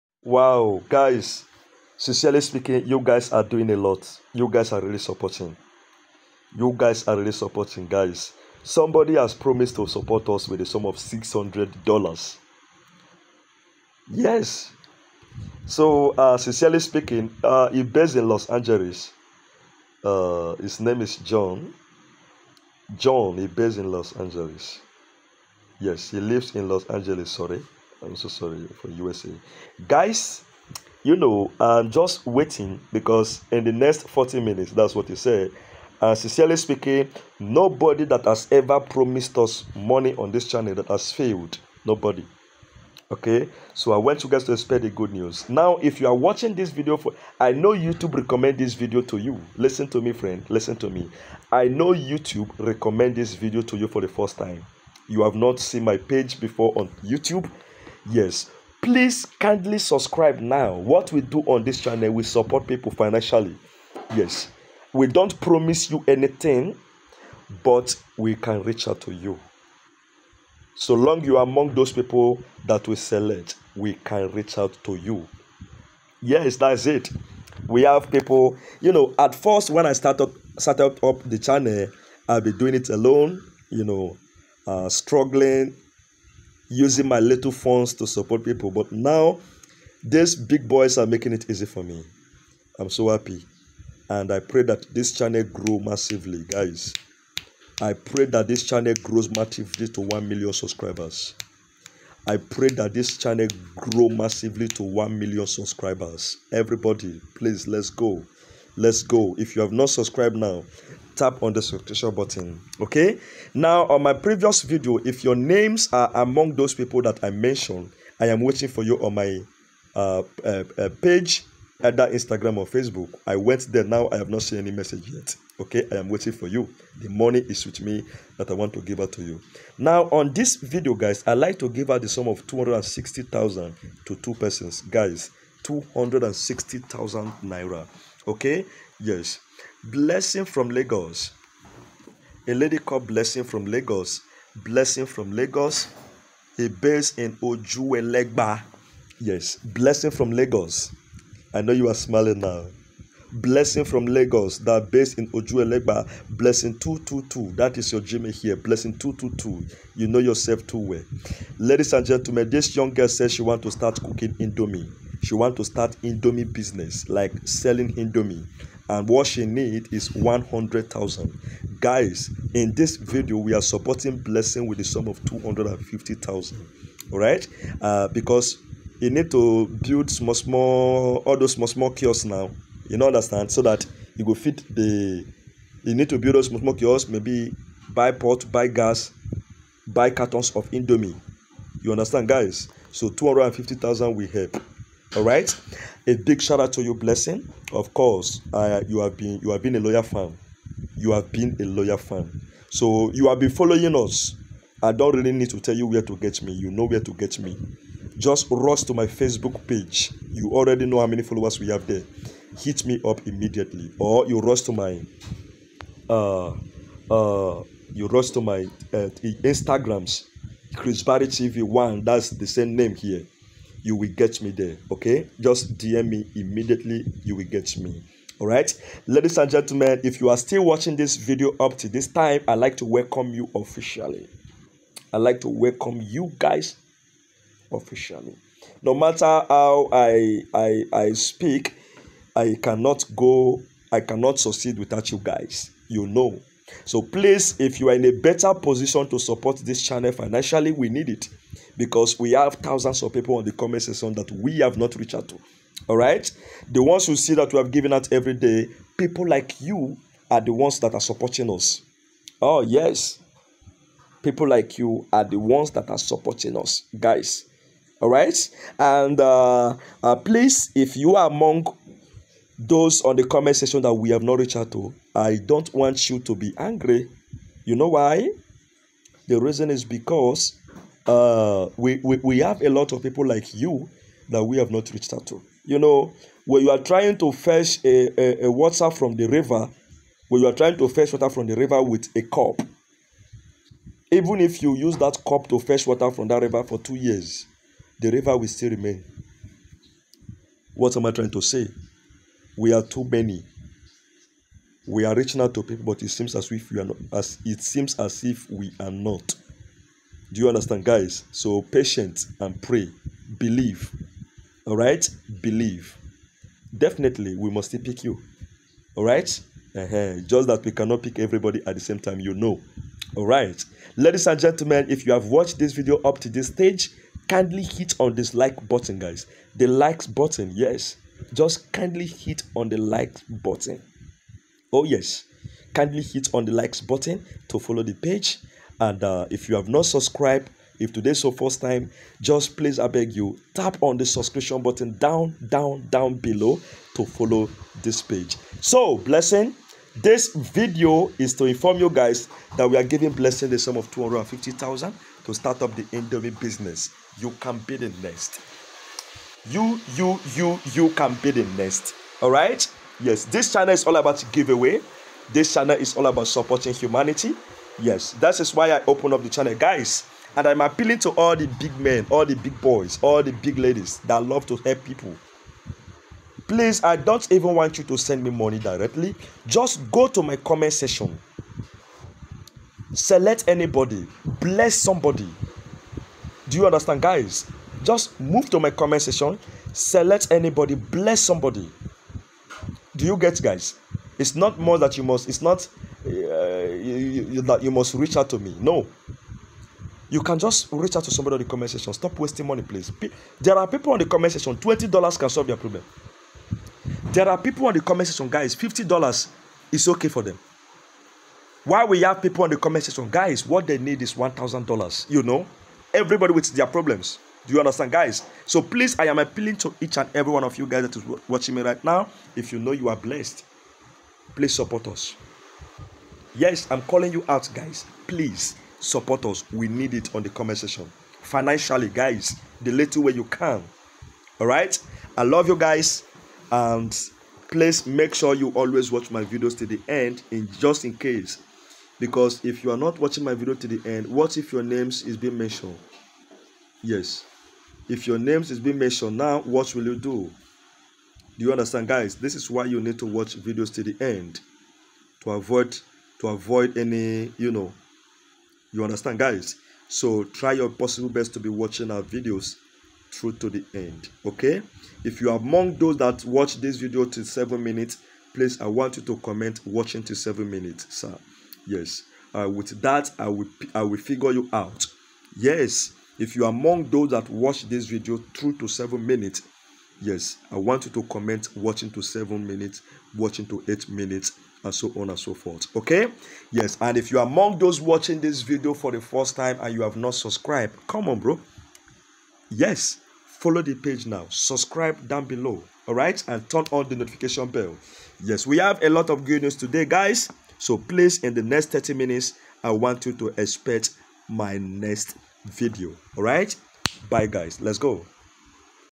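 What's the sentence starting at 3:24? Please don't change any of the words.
I don't really need to tell you where to get me.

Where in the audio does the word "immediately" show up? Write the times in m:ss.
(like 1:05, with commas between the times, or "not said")
3:33, 3:46.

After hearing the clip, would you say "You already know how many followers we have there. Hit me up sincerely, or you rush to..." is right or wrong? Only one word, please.
wrong.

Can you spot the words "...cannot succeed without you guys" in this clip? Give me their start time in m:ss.
4:03.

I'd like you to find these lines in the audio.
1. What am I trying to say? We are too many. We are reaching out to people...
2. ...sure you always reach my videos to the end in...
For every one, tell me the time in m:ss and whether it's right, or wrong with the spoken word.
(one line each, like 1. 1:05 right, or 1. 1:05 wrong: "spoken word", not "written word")
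1. 5:00 right
2. 7:18 wrong: "watch", not "reach".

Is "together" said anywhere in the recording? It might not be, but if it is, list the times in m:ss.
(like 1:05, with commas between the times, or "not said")
not said.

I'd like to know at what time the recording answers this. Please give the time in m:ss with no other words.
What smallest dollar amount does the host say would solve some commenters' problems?
6:44.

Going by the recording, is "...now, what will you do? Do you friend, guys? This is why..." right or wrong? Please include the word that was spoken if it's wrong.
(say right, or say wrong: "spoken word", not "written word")
wrong: "understand", not "friend".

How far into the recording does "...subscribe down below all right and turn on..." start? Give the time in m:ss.
8:14.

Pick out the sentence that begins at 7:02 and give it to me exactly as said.
If you know you are blessed, please support us.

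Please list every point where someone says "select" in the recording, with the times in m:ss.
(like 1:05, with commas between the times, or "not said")
1:12, 6:22, 6:29.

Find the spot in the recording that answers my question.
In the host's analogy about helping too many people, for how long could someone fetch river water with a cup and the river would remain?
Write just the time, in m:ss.
4:56.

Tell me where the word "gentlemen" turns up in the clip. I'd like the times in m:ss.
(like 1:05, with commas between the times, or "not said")
2:42, 3:49, 5:24.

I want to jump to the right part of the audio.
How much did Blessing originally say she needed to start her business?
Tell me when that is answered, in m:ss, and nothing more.
2:50.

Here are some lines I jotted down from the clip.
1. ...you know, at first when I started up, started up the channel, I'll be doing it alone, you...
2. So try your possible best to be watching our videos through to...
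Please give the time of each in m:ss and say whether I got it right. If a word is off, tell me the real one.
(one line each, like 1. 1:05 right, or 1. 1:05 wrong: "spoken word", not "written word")
1. 1:18 right
2. 7:39 right.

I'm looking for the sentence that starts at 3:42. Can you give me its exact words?
That's the same name here you will get me there.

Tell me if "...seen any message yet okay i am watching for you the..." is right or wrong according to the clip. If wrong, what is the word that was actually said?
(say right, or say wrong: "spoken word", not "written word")
wrong: "waiting", not "watching".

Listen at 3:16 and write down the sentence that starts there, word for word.
A big shout out to you, Blessing.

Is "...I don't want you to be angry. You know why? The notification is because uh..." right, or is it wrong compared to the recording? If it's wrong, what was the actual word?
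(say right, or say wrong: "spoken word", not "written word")
wrong: "reason", not "notification".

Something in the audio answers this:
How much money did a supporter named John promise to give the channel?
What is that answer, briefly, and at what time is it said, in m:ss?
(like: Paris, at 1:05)
$600, at 0:10.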